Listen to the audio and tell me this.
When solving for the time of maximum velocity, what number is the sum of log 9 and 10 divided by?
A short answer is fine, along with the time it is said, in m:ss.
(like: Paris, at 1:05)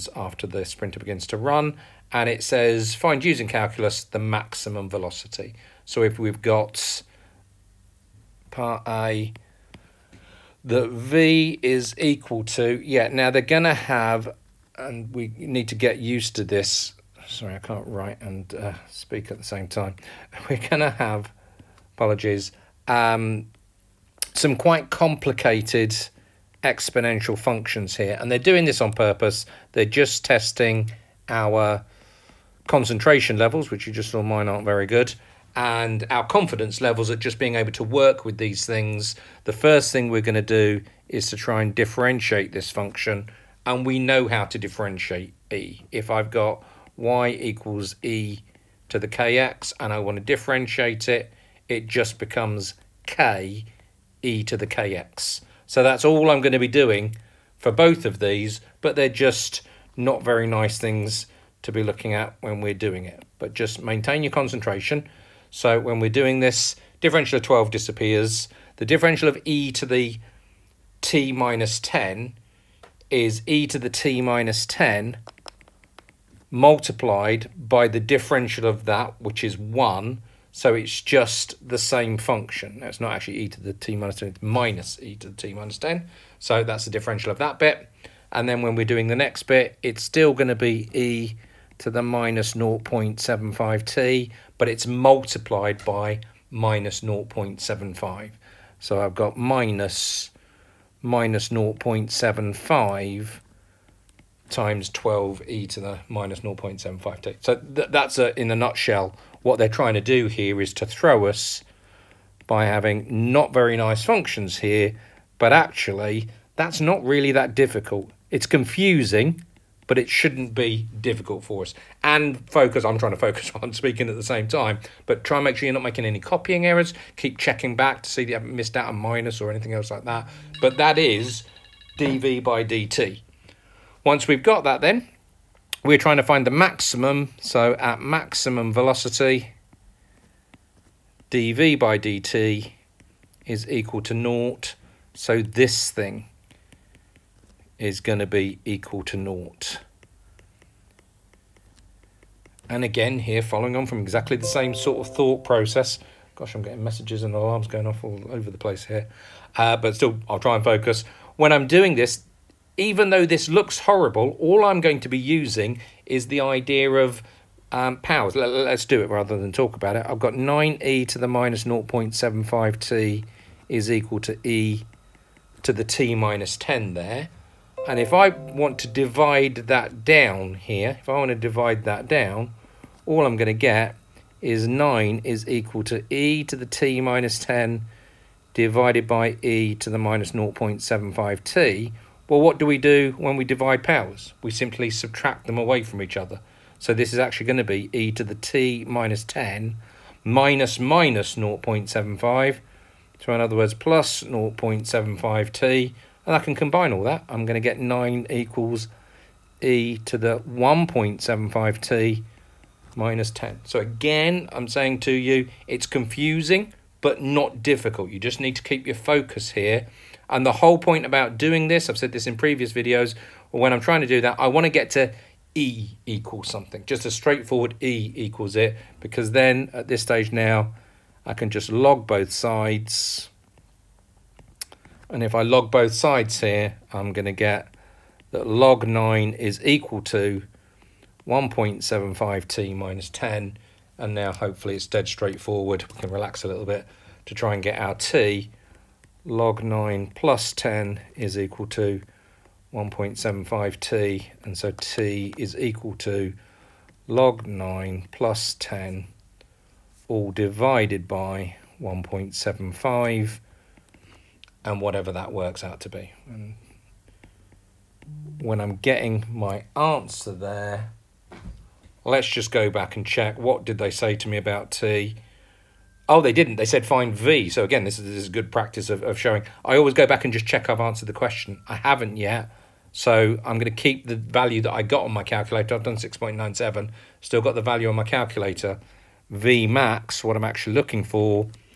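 1.75, at 4:20.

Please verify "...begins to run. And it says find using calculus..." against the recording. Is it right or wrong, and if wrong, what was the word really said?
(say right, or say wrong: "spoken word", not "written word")
right.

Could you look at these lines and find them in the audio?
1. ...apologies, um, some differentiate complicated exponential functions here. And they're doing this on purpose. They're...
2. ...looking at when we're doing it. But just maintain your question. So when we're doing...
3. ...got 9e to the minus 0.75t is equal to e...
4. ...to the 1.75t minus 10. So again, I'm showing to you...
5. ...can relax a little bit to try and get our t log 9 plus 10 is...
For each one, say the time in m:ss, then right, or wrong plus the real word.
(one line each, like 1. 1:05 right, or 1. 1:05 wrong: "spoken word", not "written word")
1. 0:21 wrong: "quite", not "differentiate"
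2. 1:01 wrong: "concentration", not "question"
3. 2:50 right
4. 3:30 wrong: "saying", not "showing"
5. 4:06 right.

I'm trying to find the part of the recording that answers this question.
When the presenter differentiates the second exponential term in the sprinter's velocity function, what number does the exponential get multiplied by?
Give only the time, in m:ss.
1:34.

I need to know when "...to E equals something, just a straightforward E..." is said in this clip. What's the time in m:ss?
3:44.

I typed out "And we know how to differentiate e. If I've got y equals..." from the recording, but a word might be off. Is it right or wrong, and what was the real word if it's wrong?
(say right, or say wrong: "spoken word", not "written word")
right.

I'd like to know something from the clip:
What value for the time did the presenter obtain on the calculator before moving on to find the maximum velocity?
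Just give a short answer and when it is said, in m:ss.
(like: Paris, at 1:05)
6.97, at 4:45.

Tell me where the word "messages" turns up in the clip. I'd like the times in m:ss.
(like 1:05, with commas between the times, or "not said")
2:36.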